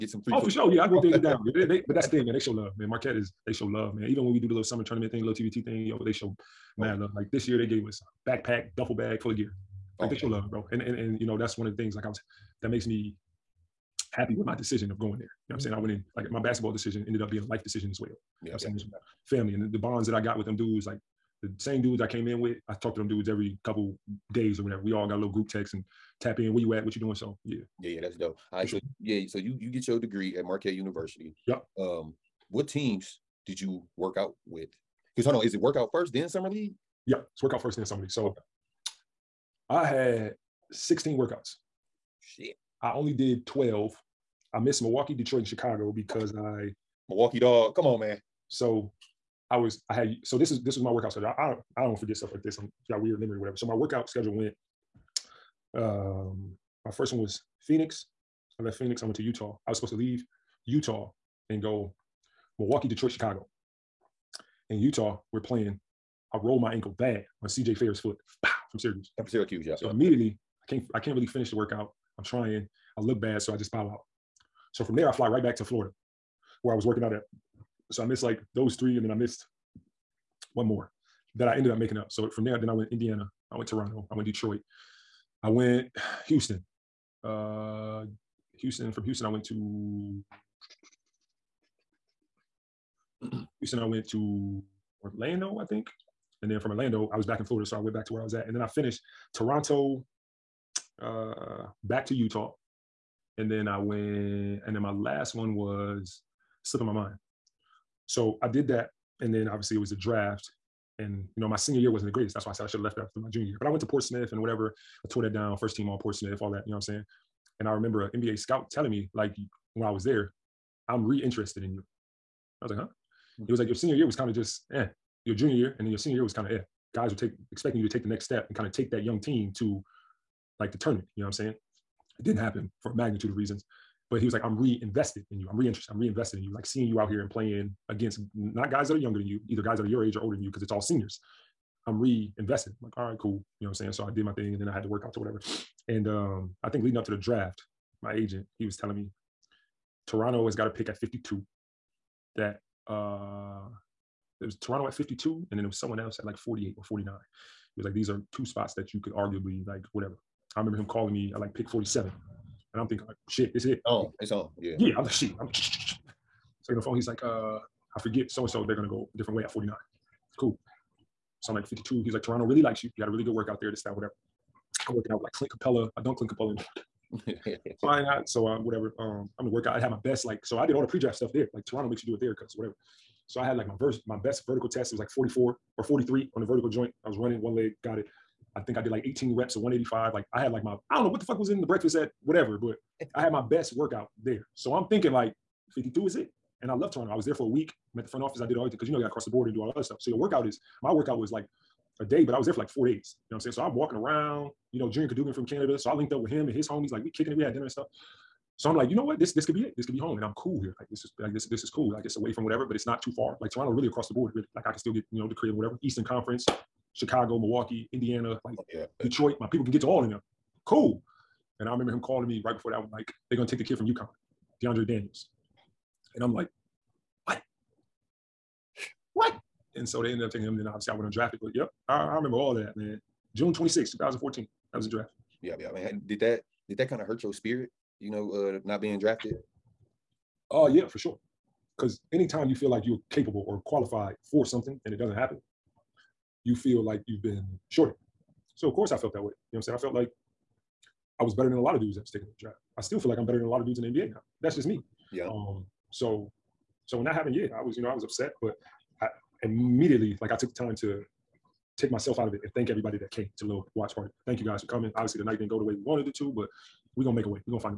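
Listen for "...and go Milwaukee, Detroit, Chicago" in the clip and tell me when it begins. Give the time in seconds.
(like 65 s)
61 s.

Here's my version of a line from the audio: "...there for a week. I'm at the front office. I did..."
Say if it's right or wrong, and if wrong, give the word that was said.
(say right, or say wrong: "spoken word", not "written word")
right.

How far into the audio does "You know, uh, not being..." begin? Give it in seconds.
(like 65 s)
238 s.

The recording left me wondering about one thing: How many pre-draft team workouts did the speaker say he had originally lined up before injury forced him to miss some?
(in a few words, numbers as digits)
16.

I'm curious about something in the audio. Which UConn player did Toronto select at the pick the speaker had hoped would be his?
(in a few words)
DeAndre Daniels.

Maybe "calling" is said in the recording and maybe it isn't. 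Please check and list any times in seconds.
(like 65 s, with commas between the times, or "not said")
160 s, 221 s.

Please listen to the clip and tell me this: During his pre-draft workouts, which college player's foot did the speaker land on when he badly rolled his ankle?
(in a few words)
CJ Fair.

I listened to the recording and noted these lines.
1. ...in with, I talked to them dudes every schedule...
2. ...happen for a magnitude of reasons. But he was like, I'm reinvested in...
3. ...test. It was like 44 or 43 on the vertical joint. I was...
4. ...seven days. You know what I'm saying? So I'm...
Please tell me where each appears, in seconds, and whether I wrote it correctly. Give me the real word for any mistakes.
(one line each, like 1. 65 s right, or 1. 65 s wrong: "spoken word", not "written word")
1. 22 s wrong: "couple", not "schedule"
2. 132 s right
3. 184 s right
4. 202 s wrong: "four", not "seven".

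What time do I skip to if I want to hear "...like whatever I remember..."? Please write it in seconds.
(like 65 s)
159 s.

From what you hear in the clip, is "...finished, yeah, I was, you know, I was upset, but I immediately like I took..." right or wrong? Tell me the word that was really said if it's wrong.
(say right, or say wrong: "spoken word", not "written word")
wrong: "happened", not "finished".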